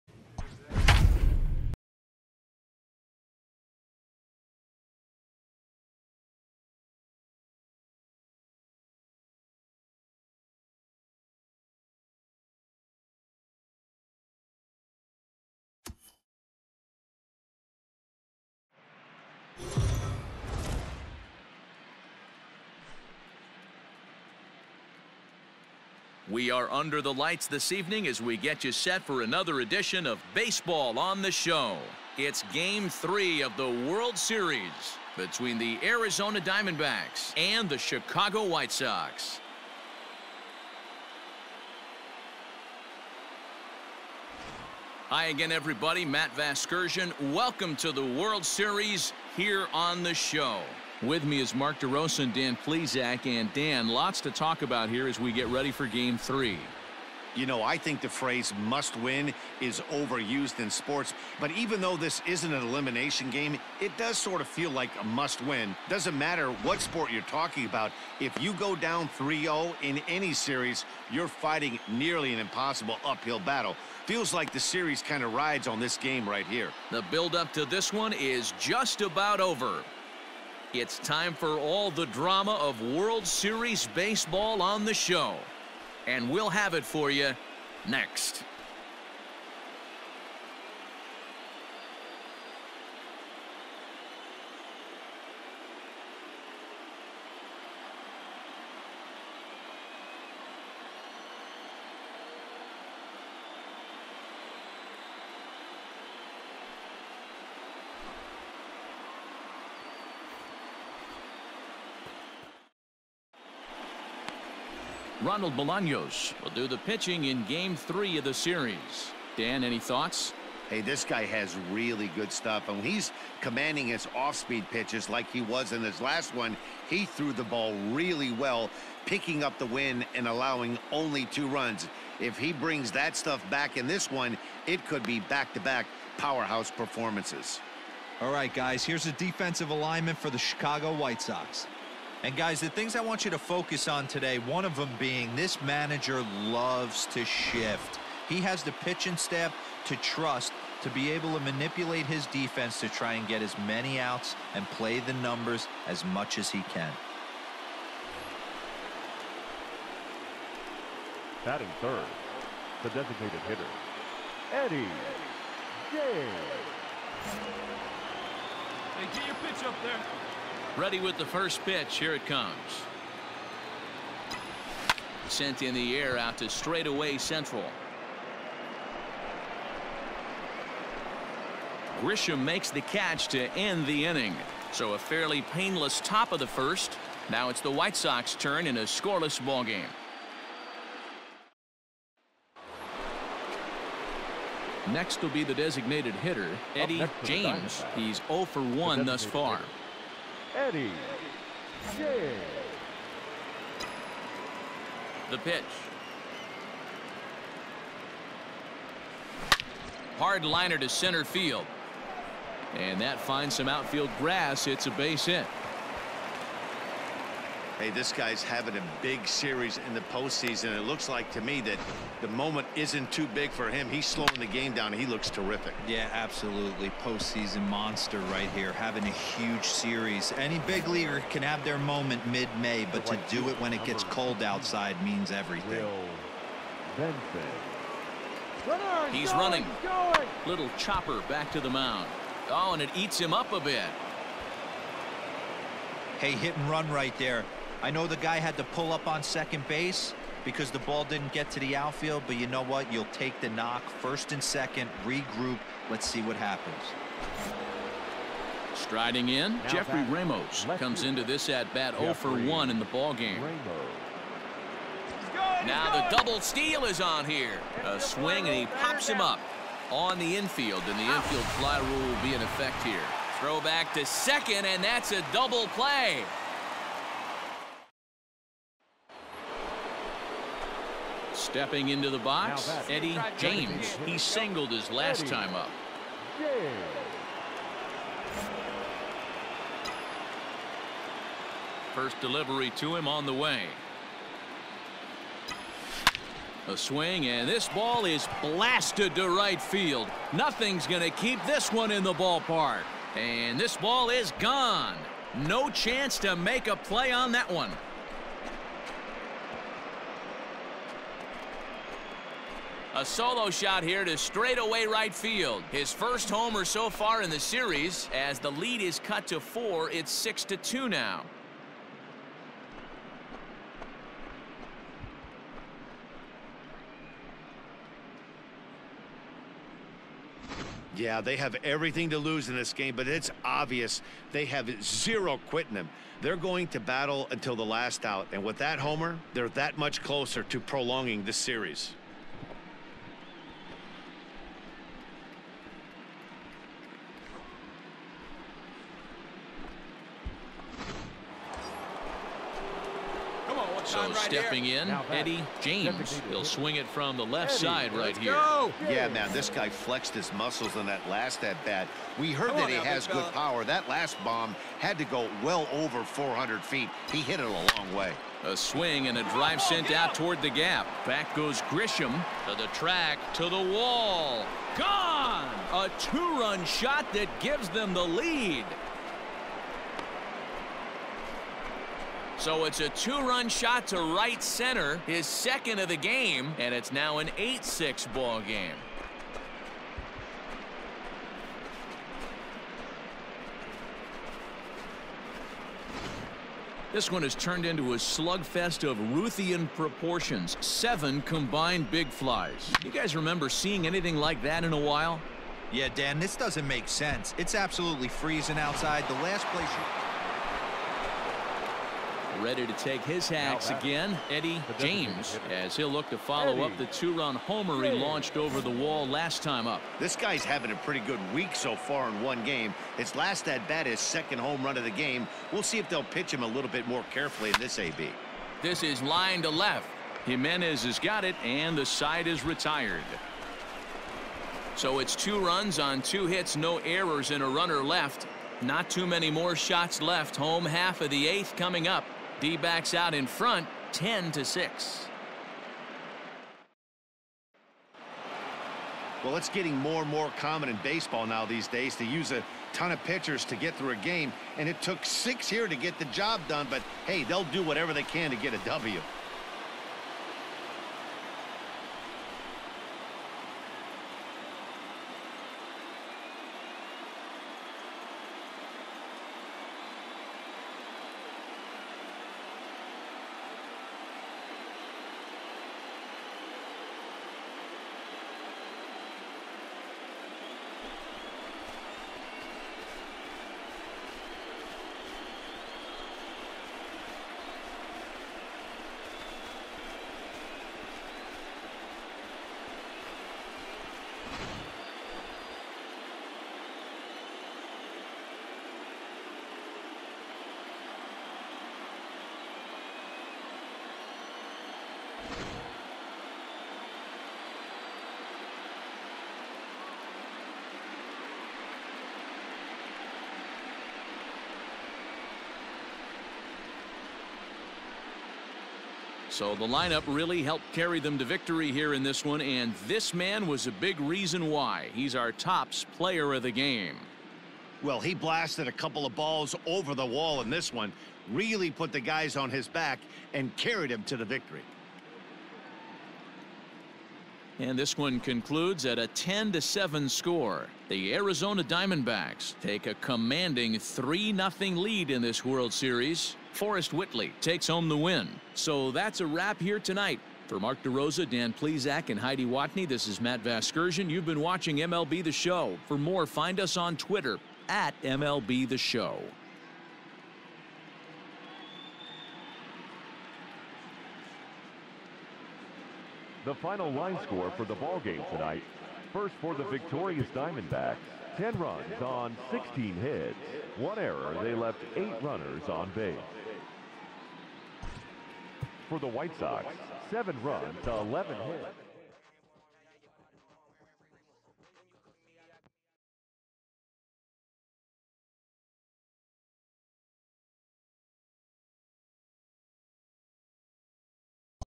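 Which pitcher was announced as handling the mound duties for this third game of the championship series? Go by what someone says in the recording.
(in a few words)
Ronald Bolaños.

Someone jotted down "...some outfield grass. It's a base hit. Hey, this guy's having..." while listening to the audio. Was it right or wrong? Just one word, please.
right.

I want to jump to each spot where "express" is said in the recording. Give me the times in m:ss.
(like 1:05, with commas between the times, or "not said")
not said.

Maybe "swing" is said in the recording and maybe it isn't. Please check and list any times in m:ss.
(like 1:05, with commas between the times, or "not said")
4:27, 4:56, 5:56, 6:08.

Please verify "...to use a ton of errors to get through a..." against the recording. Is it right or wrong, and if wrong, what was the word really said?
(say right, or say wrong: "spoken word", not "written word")
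wrong: "pitchers", not "errors".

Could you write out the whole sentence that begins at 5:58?
Yeah, man, this guy flexed his muscles on that last at-bat.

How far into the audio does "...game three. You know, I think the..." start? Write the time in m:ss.
0:55.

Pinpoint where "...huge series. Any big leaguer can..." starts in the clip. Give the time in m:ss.
3:49.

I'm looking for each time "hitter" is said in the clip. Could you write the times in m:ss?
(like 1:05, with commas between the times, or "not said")
2:43, 3:16.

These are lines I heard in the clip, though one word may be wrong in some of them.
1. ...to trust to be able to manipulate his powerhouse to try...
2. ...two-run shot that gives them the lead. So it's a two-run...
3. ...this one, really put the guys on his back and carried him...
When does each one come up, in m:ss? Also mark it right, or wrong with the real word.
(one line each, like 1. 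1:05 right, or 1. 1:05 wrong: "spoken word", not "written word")
1. 2:29 wrong: "defense", not "powerhouse"
2. 6:15 right
3. 8:50 right.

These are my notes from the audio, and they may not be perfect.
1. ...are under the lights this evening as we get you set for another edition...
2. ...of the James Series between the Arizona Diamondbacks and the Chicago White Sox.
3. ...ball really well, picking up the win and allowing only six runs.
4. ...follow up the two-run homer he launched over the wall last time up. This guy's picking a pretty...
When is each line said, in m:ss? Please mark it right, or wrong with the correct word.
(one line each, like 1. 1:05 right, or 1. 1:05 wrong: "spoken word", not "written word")
1. 0:26 right
2. 0:33 wrong: "World", not "James"
3. 2:07 wrong: "two", not "six"
4. 6:56 wrong: "having", not "picking".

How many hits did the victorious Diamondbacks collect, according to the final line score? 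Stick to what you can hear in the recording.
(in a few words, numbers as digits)
16.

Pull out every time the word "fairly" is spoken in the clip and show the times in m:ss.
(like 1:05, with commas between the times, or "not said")
3:04.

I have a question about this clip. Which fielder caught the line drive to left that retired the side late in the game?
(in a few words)
Jimenez.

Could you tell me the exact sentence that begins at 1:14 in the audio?
Feels like the series kind of rides on this game right here.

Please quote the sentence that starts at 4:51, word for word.
First delivery to him on the way.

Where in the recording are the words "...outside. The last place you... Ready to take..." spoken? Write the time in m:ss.
6:48.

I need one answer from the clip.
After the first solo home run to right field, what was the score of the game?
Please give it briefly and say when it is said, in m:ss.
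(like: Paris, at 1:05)
6-2, at 5:20.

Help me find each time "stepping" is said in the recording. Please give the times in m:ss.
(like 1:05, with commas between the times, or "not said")
4:41, 5:54.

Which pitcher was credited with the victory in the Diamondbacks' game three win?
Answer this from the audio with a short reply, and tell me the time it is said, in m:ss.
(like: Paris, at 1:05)
Forrest Whitley, at 9:06.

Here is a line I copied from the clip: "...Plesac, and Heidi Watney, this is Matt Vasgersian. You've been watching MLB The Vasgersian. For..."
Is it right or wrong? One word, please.
wrong.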